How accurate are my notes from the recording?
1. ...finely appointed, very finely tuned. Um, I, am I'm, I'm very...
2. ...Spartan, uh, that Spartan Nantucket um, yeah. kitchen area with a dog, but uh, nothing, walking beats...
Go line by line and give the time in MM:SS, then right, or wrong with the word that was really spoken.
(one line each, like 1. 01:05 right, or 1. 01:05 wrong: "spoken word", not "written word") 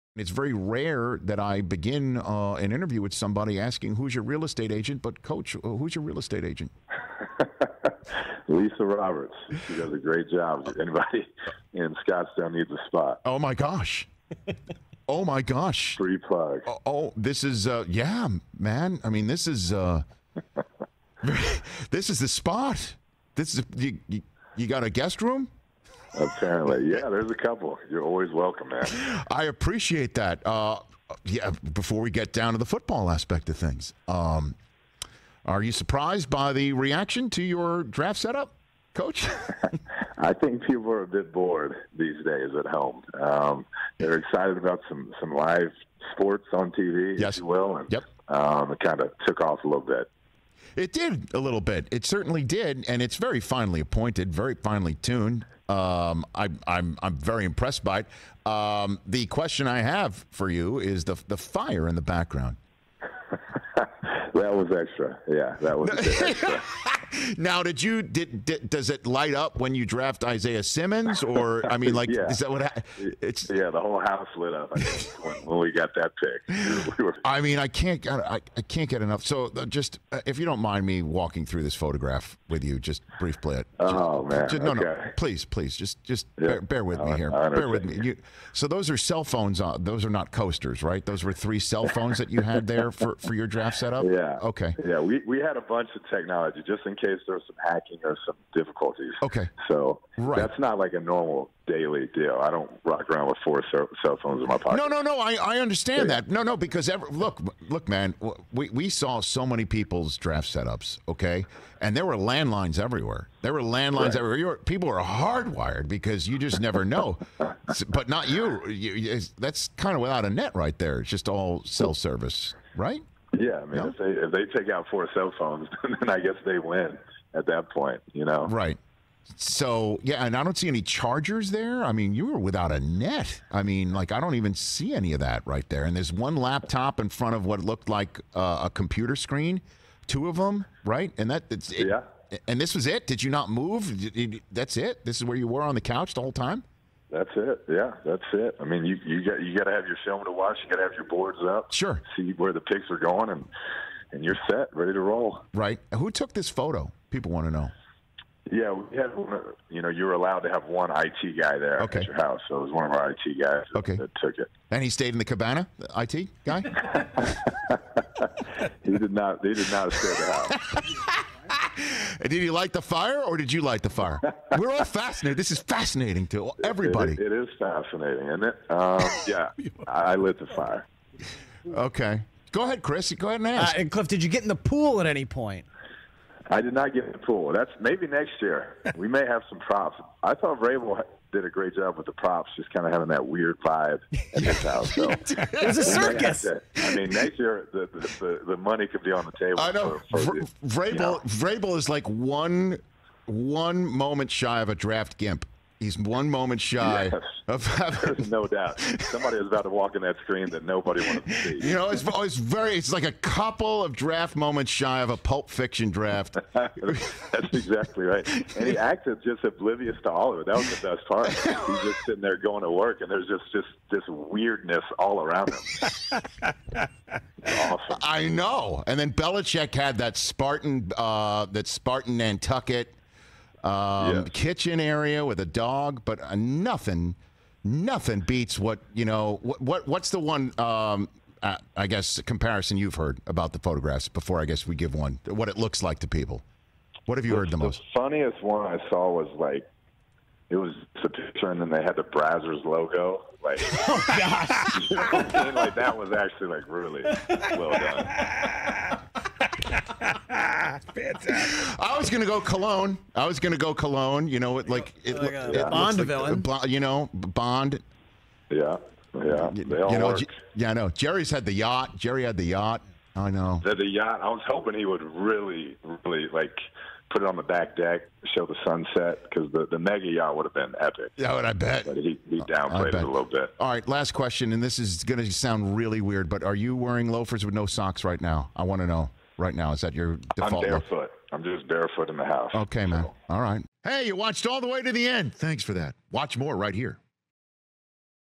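1. 00:53 right
2. 03:50 wrong: "nothing", not "walking".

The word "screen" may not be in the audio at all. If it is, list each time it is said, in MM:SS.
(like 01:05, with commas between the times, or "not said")
02:19, 03:30.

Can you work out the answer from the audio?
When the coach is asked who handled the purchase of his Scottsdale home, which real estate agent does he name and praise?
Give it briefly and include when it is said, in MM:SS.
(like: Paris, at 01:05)
Lisa Roberts, at 00:08.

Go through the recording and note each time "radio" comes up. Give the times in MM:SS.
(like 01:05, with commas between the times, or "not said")
not said.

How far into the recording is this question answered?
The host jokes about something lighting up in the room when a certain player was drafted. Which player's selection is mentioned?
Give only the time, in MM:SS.
01:10.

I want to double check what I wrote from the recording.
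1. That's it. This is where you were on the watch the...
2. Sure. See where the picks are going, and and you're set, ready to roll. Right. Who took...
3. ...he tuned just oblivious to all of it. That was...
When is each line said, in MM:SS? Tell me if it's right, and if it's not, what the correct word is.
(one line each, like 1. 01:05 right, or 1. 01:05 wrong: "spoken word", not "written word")
1. 02:24 wrong: "couch", not "watch"
2. 02:31 right
3. 03:38 wrong: "acted", not "tuned".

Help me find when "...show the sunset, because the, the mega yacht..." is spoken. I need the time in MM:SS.
04:38.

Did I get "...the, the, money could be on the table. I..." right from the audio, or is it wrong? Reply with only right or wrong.
right.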